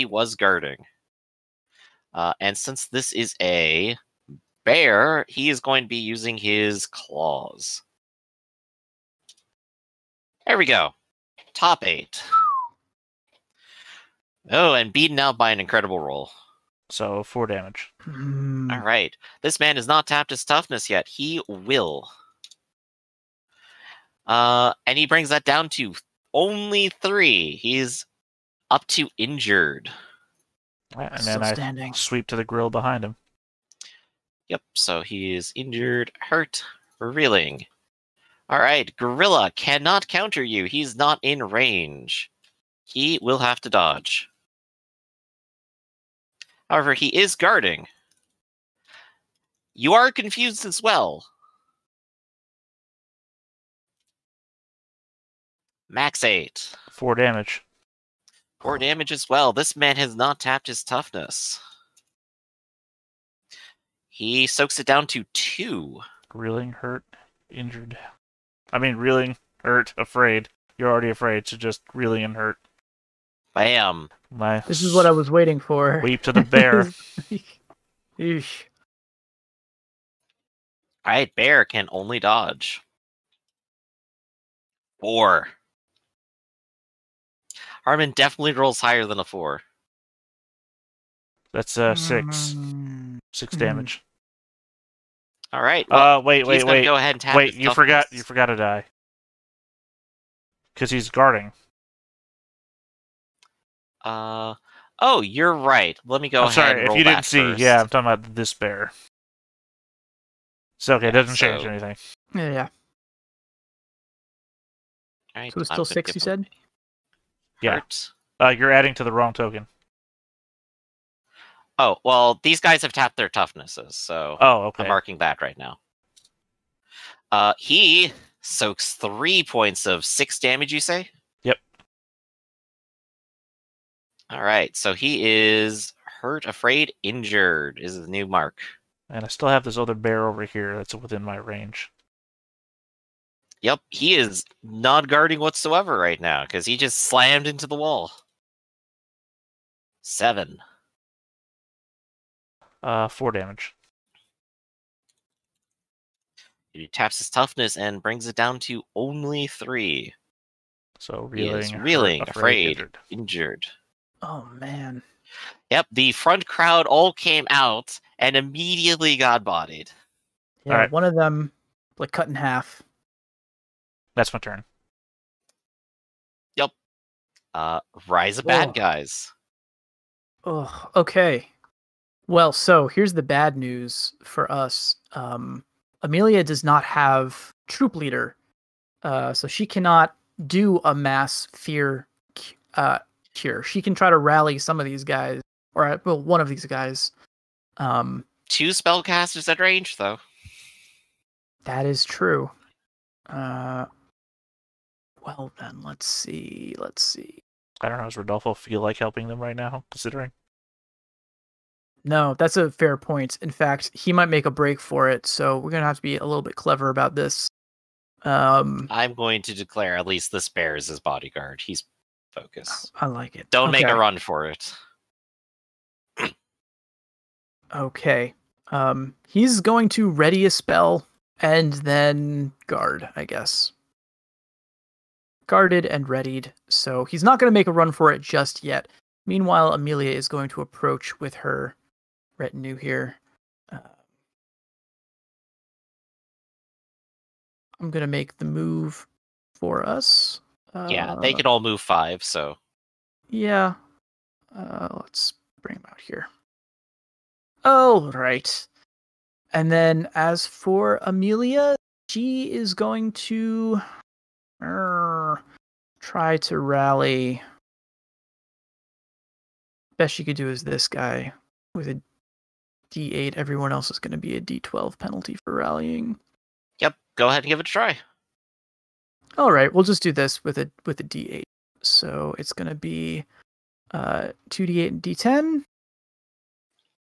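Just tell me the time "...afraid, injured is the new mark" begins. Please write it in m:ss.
2:16.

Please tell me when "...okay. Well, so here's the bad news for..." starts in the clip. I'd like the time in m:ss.
3:00.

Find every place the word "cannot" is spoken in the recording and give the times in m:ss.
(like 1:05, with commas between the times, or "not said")
0:39, 3:09.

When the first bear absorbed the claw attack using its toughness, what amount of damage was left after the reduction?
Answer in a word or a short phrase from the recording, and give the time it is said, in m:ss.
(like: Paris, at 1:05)
3, at 0:25.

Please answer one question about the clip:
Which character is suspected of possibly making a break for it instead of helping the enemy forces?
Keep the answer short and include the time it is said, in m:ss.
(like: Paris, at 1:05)
Rodolfo, at 3:28.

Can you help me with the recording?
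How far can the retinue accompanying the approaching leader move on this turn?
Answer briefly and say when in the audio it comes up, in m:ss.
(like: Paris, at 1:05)
5, at 4:11.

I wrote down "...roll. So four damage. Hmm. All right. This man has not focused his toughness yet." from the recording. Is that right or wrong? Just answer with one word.
wrong.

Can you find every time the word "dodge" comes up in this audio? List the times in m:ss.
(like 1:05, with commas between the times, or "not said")
0:43, 1:22.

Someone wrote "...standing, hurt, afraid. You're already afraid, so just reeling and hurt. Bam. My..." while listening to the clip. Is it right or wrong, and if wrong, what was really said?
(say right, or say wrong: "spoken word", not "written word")
wrong: "reeling", not "standing".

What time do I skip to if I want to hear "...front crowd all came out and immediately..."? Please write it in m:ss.
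2:46.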